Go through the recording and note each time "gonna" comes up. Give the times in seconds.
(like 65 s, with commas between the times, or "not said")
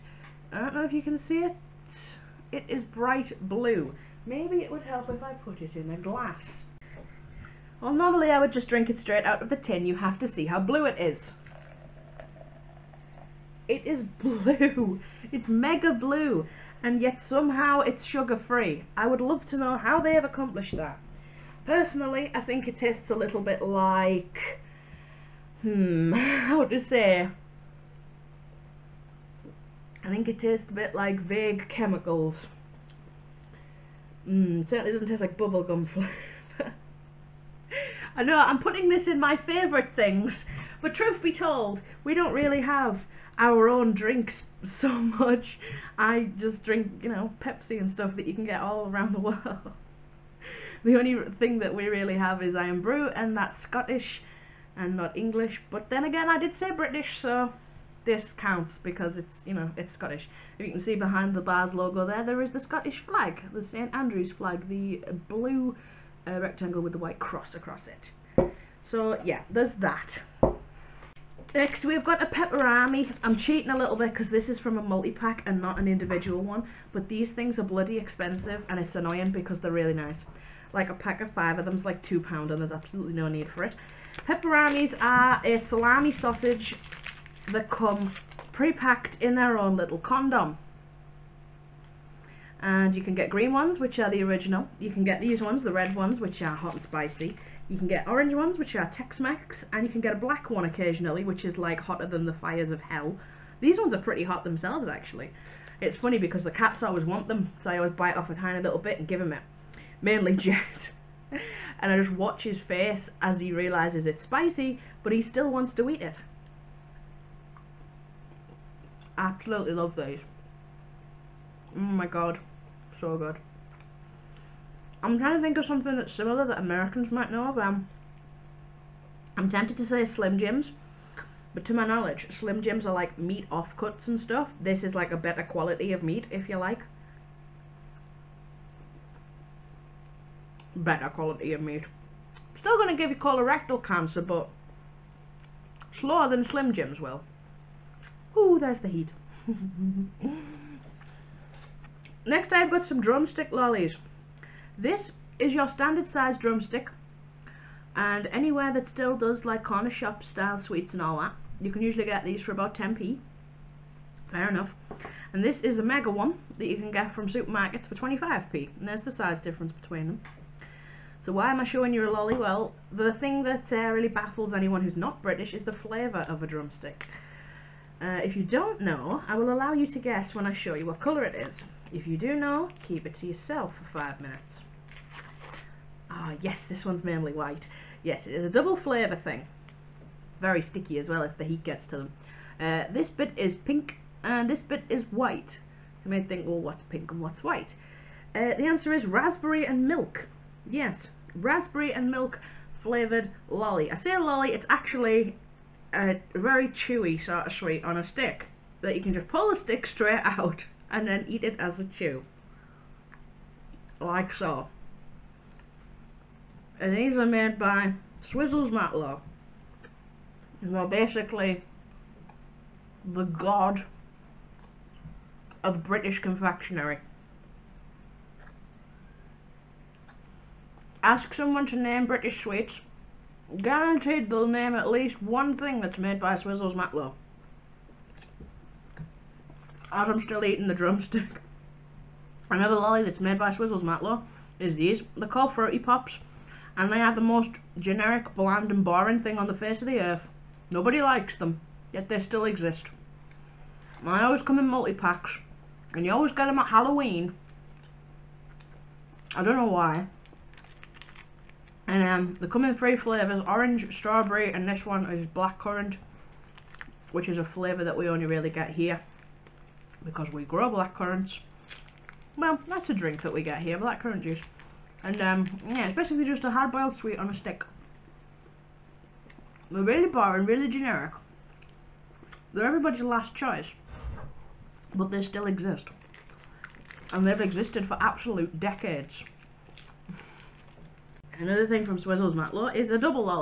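142 s.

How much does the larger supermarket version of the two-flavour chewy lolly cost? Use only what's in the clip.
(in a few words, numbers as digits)
25p.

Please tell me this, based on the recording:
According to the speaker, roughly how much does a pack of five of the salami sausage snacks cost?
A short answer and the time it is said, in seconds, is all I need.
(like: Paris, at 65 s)
2 pounds, at 82 s.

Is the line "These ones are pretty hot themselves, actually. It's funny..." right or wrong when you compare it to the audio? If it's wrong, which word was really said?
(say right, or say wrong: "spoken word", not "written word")
right.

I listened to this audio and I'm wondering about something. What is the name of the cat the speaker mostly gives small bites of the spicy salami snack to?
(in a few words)
Jet.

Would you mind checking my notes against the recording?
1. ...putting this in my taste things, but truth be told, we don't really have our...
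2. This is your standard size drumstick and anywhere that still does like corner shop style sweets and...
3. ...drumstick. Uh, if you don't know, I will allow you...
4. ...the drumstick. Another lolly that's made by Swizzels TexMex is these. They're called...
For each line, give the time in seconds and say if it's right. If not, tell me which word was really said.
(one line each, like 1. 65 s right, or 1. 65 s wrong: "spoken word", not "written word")
1. 38 s wrong: "favourite", not "taste"
2. 154 s right
3. 176 s right
4. 240 s wrong: "Matlow", not "TexMex".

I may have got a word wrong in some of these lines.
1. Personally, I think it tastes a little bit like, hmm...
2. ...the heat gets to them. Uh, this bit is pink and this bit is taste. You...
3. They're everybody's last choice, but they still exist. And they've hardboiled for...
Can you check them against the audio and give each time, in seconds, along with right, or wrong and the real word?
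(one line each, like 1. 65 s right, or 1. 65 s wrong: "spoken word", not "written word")
1. 21 s right
2. 191 s wrong: "white", not "taste"
3. 282 s wrong: "existed", not "hardboiled".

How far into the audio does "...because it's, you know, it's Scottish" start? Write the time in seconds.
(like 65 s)
58 s.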